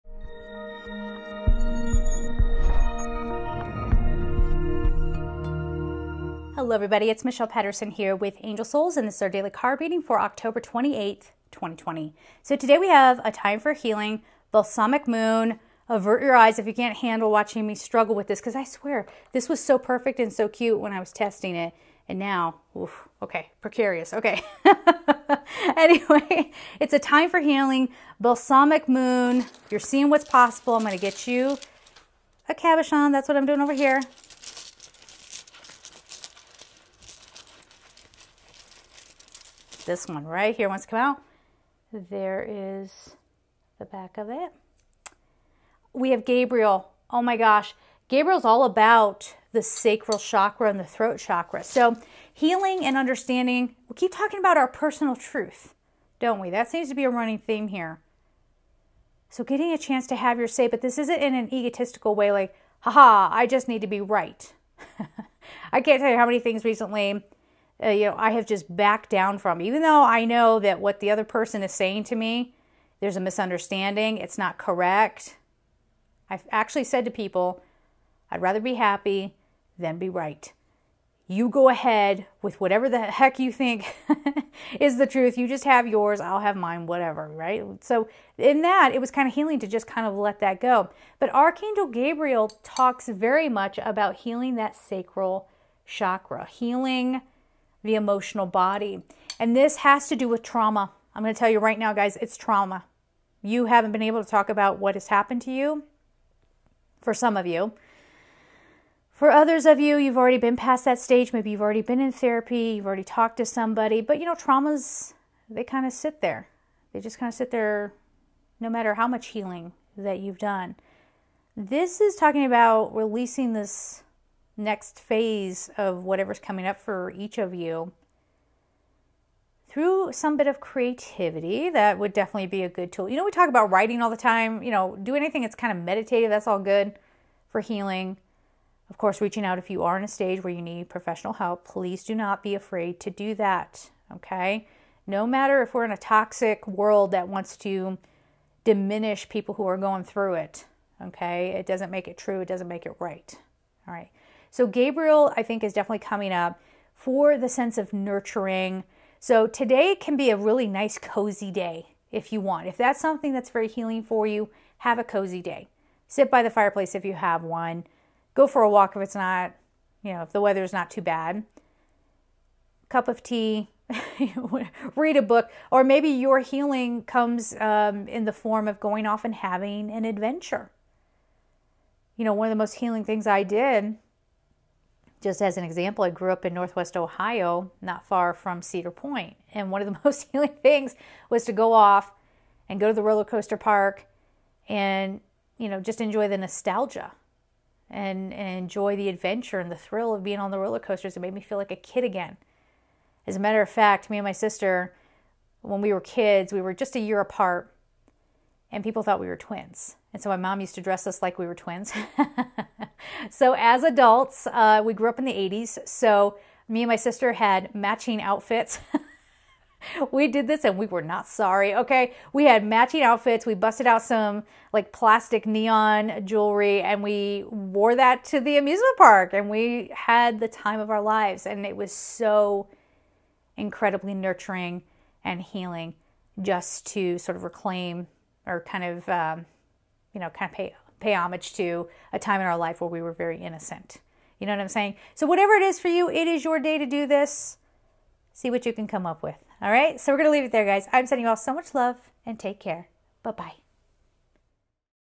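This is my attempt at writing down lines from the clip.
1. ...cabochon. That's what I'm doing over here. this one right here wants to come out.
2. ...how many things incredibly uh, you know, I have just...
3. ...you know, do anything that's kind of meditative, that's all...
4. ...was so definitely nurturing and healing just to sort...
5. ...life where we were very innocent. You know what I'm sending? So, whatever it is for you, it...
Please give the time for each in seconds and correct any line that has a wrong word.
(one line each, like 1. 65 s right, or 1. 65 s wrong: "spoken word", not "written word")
1. 32 s right
2. 66 s wrong: "recently", not "incredibly"
3. 134 s right
4. 231 s wrong: "incredibly", not "definitely"
5. 242 s wrong: "saying", not "sending".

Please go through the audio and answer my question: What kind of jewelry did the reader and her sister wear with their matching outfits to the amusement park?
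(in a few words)
plastic neon jewelry.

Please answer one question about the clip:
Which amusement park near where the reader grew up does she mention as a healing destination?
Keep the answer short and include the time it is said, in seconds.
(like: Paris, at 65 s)
Cedar Point, at 188 s.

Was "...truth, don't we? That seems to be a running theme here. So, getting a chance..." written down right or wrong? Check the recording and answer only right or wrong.
right.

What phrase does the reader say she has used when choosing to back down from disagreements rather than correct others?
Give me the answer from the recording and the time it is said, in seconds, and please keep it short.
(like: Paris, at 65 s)
I'd rather be happy than be right, at 78 s.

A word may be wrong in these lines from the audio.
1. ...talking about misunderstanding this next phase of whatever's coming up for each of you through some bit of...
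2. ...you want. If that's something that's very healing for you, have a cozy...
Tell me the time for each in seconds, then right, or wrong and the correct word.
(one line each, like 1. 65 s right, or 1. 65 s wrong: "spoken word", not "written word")
1. 122 s wrong: "releasing", not "misunderstanding"
2. 162 s right.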